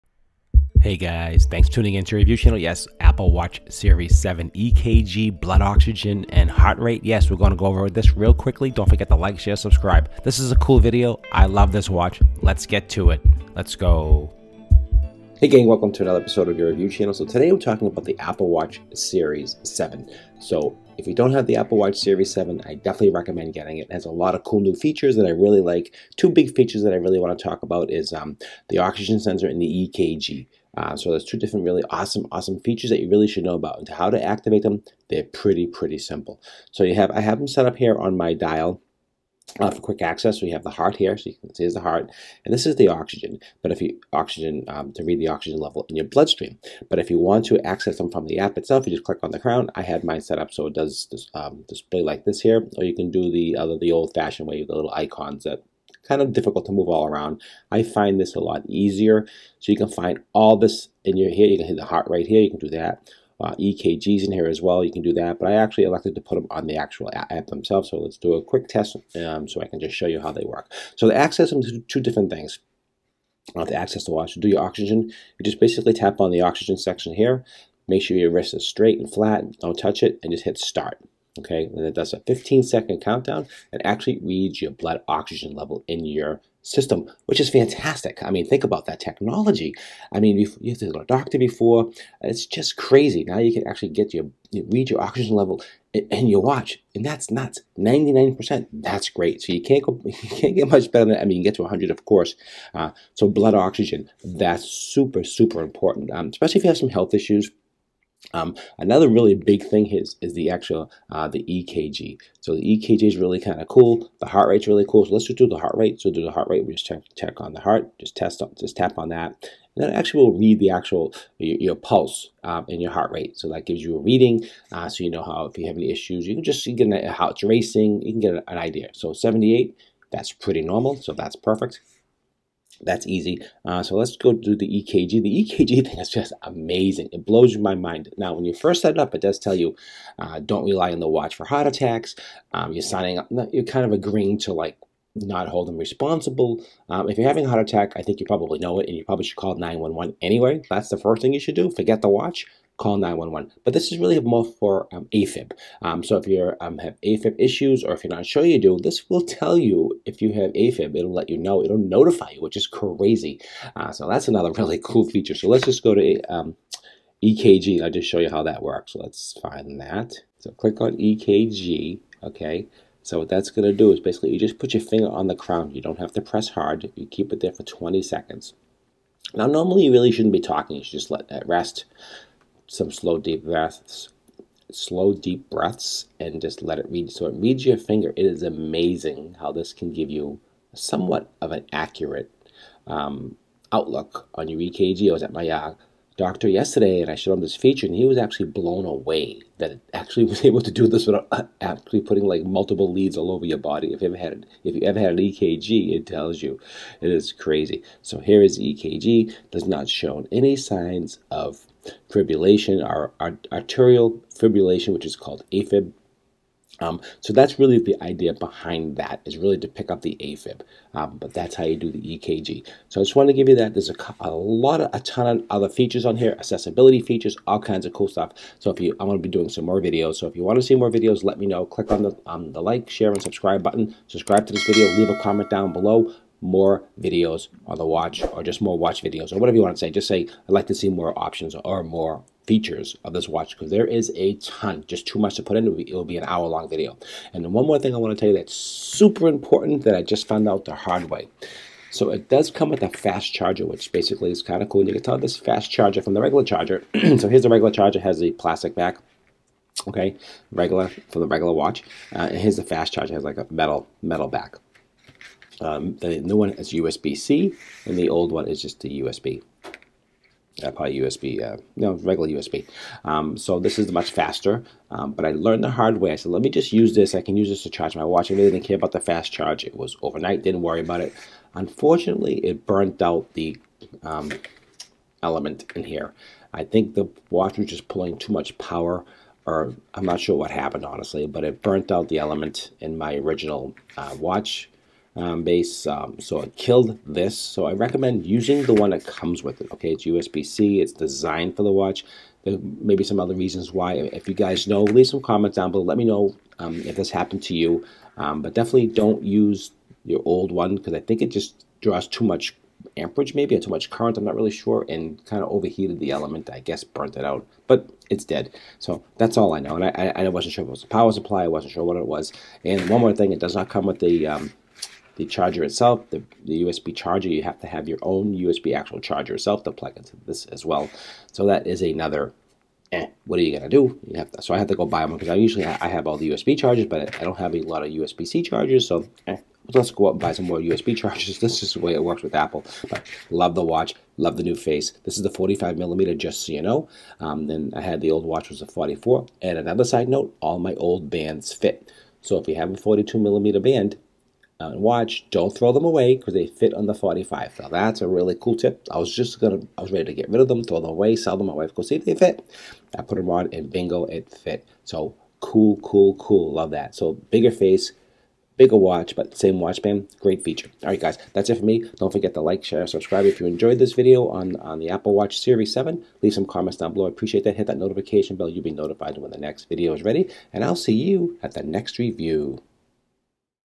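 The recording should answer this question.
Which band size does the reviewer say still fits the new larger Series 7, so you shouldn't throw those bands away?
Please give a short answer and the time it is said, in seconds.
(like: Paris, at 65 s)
42 millimeter, at 352 s.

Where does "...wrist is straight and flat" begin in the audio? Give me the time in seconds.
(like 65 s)
78 s.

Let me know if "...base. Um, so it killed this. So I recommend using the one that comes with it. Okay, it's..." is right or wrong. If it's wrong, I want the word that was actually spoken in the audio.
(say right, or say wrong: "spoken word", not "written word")
right.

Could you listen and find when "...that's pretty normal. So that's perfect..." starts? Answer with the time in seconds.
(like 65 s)
130 s.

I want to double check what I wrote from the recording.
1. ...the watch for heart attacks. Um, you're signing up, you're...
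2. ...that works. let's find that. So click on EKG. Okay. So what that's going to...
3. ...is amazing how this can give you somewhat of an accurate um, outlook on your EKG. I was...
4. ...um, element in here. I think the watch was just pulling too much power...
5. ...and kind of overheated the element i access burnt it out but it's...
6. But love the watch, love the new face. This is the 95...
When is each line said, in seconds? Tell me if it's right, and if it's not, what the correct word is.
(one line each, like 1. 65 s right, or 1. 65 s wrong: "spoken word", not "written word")
1. 140 s right
2. 168 s right
3. 188 s right
4. 284 s right
5. 314 s wrong: "guess", not "access"
6. 342 s wrong: "45", not "95".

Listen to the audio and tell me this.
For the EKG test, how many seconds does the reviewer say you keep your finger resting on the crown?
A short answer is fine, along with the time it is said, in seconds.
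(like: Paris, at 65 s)
20 seconds, at 177 s.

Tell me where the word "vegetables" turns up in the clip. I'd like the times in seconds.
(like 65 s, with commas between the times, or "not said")
not said.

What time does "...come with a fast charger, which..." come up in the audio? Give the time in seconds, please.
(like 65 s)
252 s.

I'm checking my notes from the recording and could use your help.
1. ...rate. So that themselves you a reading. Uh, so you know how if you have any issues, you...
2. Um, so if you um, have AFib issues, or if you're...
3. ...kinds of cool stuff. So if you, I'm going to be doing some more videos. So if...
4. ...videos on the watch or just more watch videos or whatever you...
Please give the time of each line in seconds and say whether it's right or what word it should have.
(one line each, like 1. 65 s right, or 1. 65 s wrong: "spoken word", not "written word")
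1. 123 s wrong: "gives", not "themselves"
2. 155 s right
3. 227 s right
4. 236 s right.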